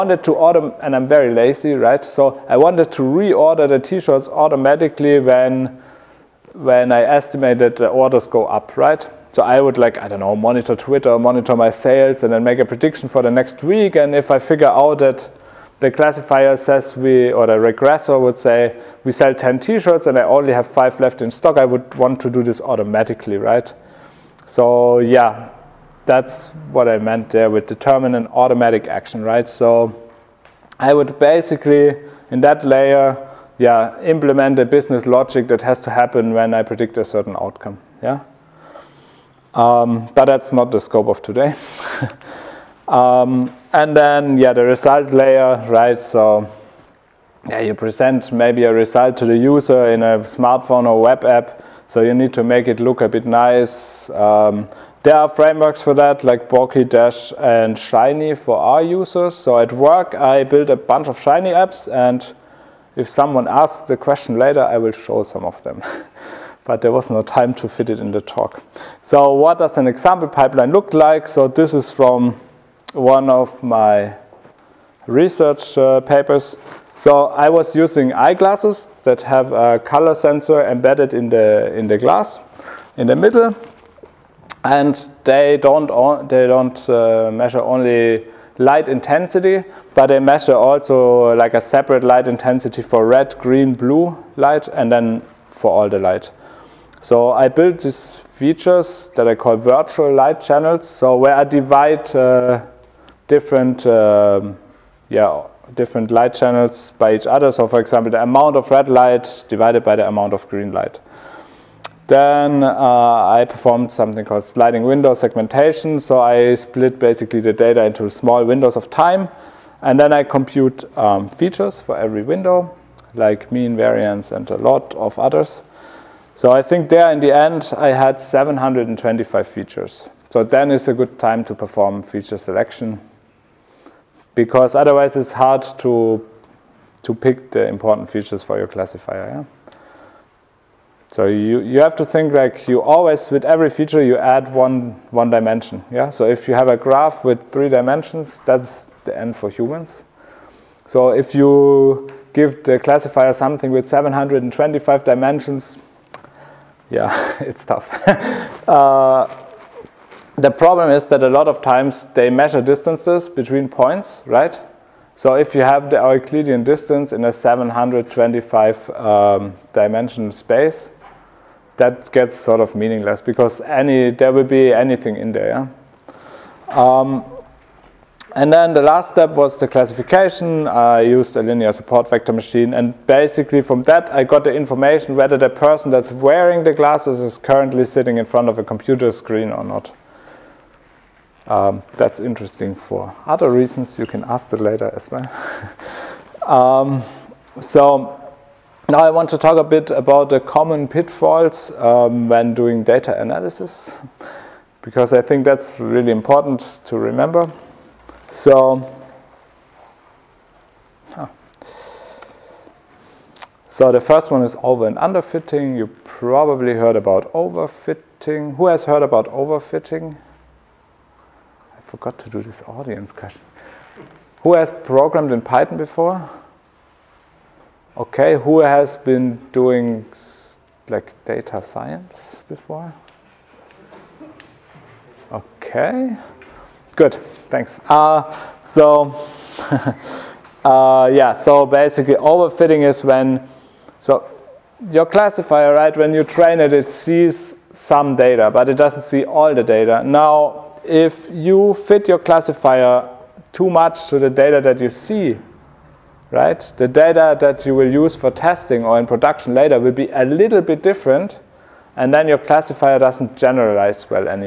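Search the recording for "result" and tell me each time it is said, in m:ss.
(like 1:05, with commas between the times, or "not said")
0:44, 0:48.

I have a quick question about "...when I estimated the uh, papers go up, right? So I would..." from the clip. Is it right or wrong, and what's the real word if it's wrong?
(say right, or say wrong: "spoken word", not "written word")
wrong: "orders", not "papers".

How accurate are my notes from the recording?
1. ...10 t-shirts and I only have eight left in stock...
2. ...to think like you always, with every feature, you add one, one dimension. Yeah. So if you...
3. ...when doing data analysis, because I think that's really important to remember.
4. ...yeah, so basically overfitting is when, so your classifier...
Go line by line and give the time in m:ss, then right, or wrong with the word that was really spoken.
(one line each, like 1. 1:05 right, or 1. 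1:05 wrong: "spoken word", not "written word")
1. 0:19 wrong: "five", not "eight"
2. 2:21 right
3. 3:22 right
4. 4:01 right.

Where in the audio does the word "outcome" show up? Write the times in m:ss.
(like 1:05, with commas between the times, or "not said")
0:37.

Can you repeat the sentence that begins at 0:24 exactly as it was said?
So yeah, that's what I meant there with determine an automatic action, right?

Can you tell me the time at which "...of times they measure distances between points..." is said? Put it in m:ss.
2:41.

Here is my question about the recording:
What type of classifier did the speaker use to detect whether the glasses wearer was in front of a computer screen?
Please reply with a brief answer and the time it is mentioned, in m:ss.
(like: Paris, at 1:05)
linear support vector machine, at 3:01.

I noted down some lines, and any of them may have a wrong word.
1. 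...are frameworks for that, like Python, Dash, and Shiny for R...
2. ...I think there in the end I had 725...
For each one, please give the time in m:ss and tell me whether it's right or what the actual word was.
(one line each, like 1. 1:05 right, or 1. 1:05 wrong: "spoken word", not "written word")
1. 0:55 wrong: "Bokeh", not "Python"
2. 2:06 right.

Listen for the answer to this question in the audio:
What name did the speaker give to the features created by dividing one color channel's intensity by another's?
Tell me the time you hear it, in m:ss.
1:39.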